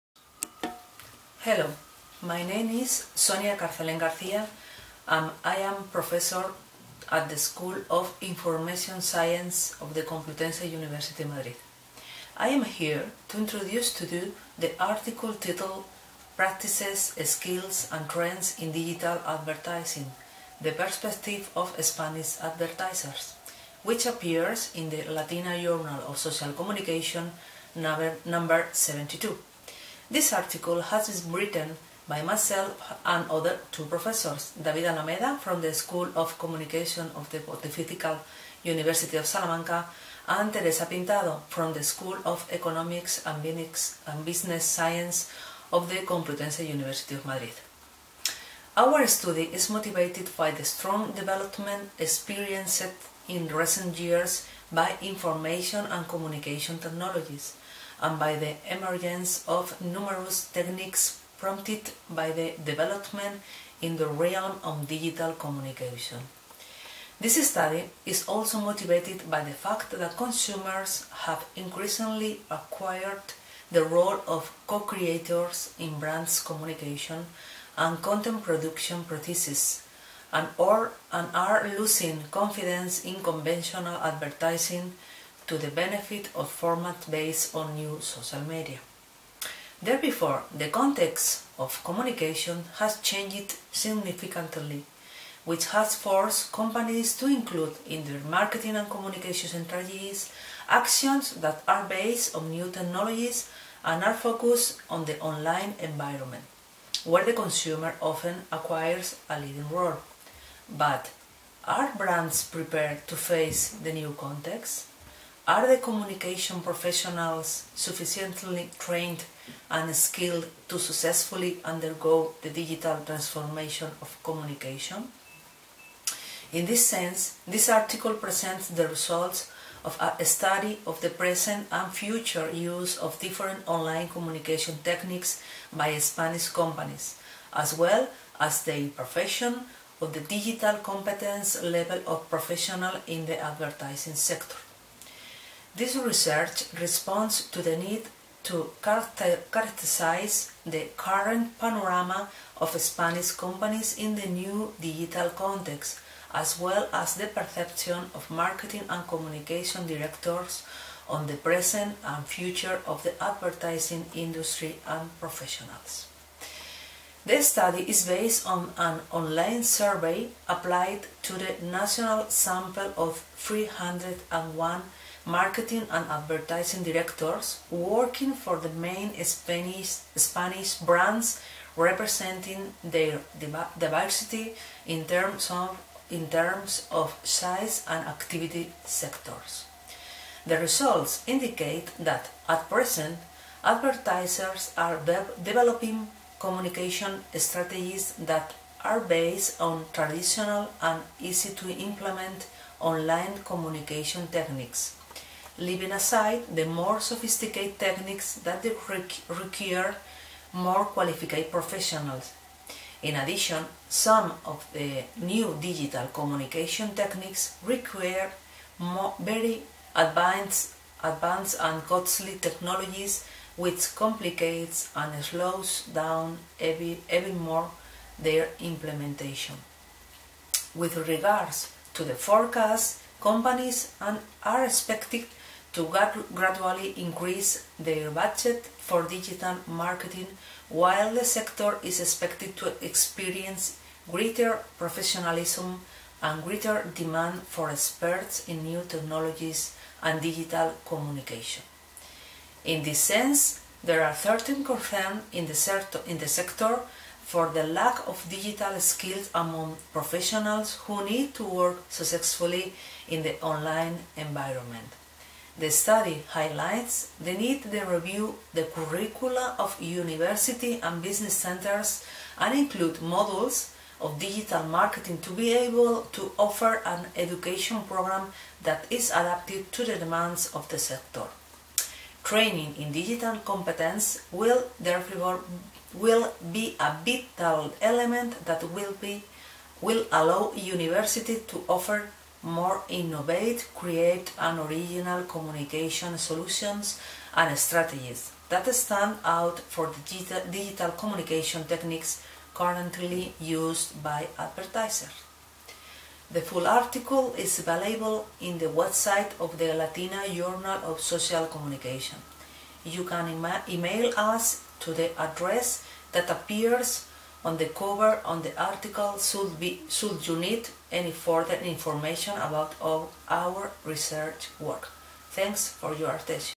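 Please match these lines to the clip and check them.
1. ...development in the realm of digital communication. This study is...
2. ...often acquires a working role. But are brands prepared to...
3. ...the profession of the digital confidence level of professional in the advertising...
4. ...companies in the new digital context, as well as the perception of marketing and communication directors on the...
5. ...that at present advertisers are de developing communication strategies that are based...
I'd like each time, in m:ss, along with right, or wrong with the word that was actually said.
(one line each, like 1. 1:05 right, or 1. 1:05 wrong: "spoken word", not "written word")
1. 1:02 right
2. 1:47 wrong: "leading", not "working"
3. 2:18 wrong: "competence", not "confidence"
4. 2:33 right
5. 3:11 right.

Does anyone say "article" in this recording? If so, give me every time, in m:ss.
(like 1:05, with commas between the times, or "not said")
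0:14, 0:30, 2:07, 5:06, 5:18.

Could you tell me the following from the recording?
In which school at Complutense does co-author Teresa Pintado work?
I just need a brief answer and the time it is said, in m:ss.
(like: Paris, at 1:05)
School of Economics and Business Science, at 0:41.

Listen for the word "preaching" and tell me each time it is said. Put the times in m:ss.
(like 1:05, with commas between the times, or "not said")
not said.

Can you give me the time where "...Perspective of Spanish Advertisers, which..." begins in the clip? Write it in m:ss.
0:20.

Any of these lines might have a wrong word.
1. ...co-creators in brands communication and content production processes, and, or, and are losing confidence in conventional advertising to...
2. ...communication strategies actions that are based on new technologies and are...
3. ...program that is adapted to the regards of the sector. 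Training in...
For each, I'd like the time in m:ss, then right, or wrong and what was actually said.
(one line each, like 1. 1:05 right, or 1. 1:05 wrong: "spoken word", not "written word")
1. 1:14 right
2. 1:38 right
3. 4:37 wrong: "demands", not "regards".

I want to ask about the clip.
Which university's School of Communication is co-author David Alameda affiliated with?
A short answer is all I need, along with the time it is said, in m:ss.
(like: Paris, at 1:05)
Pontifical University of Salamanca, at 0:37.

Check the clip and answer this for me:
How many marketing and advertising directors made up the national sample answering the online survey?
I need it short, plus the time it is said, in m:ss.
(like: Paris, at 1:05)
301, at 2:53.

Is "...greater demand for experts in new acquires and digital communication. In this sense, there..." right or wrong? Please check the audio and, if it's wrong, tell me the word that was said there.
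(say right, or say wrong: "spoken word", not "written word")
wrong: "technologies", not "acquires".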